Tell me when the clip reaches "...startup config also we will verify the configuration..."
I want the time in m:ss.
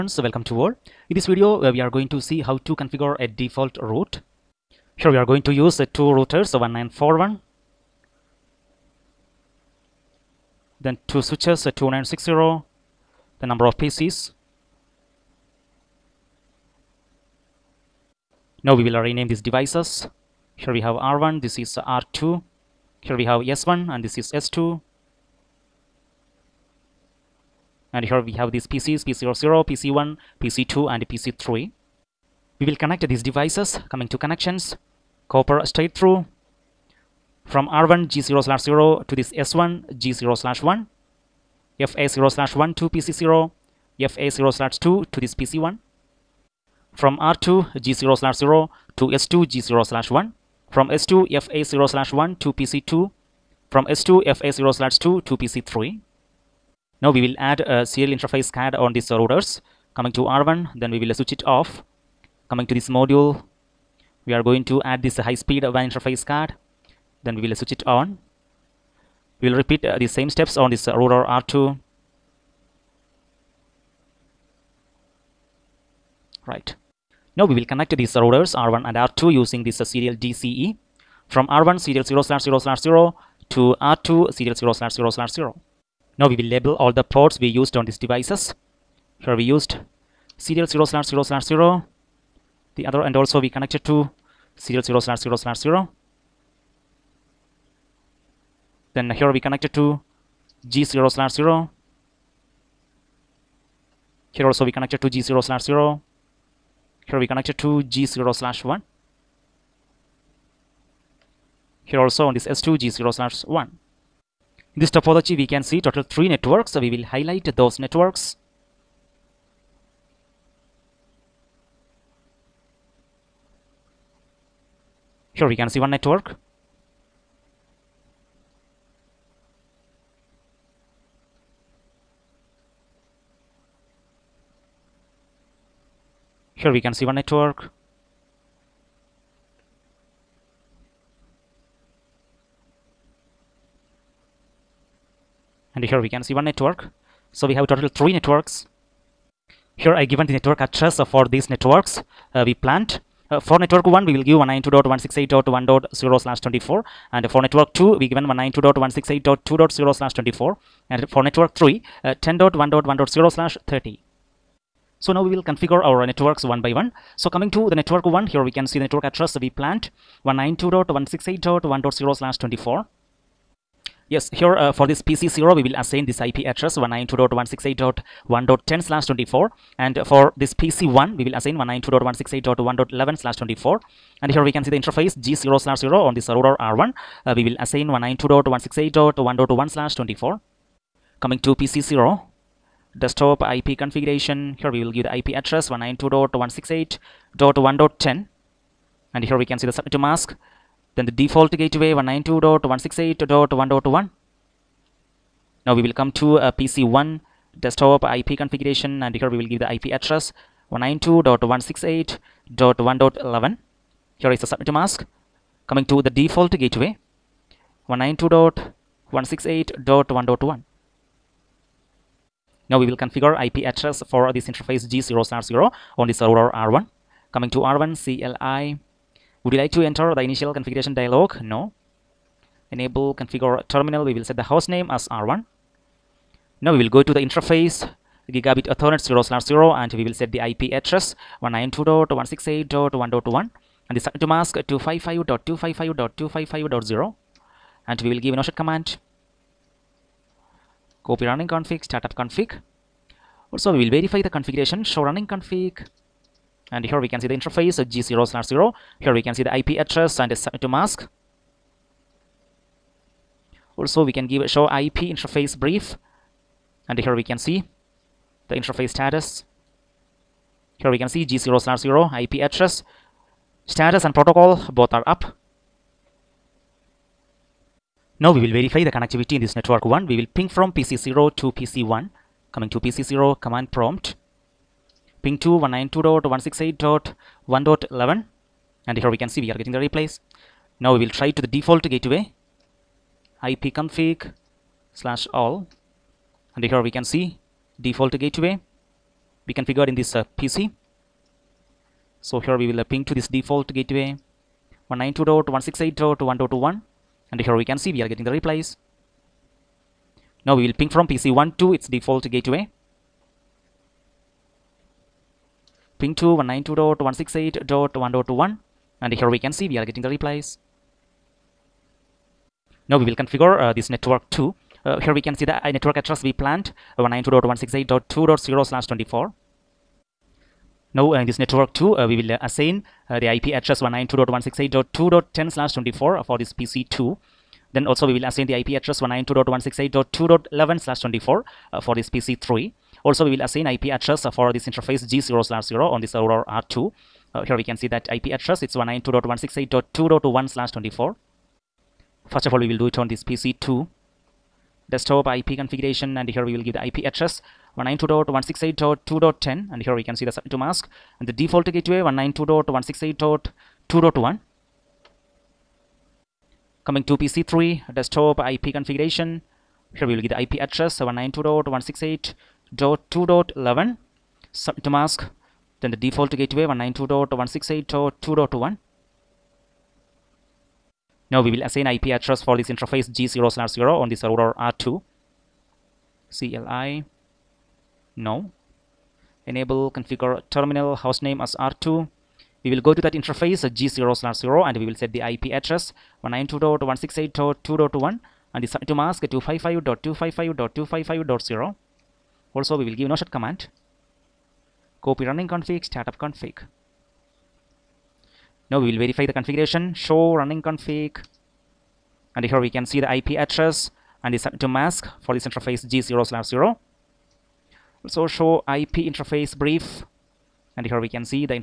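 4:11.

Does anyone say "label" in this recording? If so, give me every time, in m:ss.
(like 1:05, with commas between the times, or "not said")
1:26.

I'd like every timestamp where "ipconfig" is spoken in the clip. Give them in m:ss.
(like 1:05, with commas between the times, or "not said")
4:53.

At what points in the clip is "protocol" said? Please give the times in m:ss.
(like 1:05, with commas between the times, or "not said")
4:34.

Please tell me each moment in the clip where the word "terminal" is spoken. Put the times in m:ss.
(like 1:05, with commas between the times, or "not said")
3:53, 6:30.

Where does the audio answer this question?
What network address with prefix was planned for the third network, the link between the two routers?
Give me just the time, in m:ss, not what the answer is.
2:42.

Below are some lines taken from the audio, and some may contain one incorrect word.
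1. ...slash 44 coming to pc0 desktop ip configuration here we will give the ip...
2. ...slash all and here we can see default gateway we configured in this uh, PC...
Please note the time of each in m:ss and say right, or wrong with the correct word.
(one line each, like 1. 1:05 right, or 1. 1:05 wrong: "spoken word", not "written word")
1. 3:09 wrong: "24", not "44"
2. 4:54 right.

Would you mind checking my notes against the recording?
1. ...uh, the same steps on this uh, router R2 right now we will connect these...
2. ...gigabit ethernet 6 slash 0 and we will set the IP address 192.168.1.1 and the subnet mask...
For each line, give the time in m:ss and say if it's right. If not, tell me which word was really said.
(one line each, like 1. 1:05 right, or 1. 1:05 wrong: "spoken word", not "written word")
1. 1:09 right
2. 3:58 wrong: "0", not "6".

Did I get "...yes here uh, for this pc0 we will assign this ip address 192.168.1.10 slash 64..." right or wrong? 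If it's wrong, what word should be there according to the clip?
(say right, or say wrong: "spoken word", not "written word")
wrong: "24", not "64".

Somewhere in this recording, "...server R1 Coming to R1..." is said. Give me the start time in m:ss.
3:46.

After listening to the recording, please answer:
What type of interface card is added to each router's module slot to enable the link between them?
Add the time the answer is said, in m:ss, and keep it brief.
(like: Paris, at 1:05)
high speed WAN interface card, at 1:05.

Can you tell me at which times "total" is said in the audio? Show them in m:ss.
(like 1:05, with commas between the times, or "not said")
1:55, 2:27.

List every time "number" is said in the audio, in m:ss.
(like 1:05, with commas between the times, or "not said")
0:13.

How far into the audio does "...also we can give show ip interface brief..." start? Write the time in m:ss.
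4:23.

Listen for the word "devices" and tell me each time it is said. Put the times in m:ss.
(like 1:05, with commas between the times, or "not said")
0:19, 0:33, 1:28.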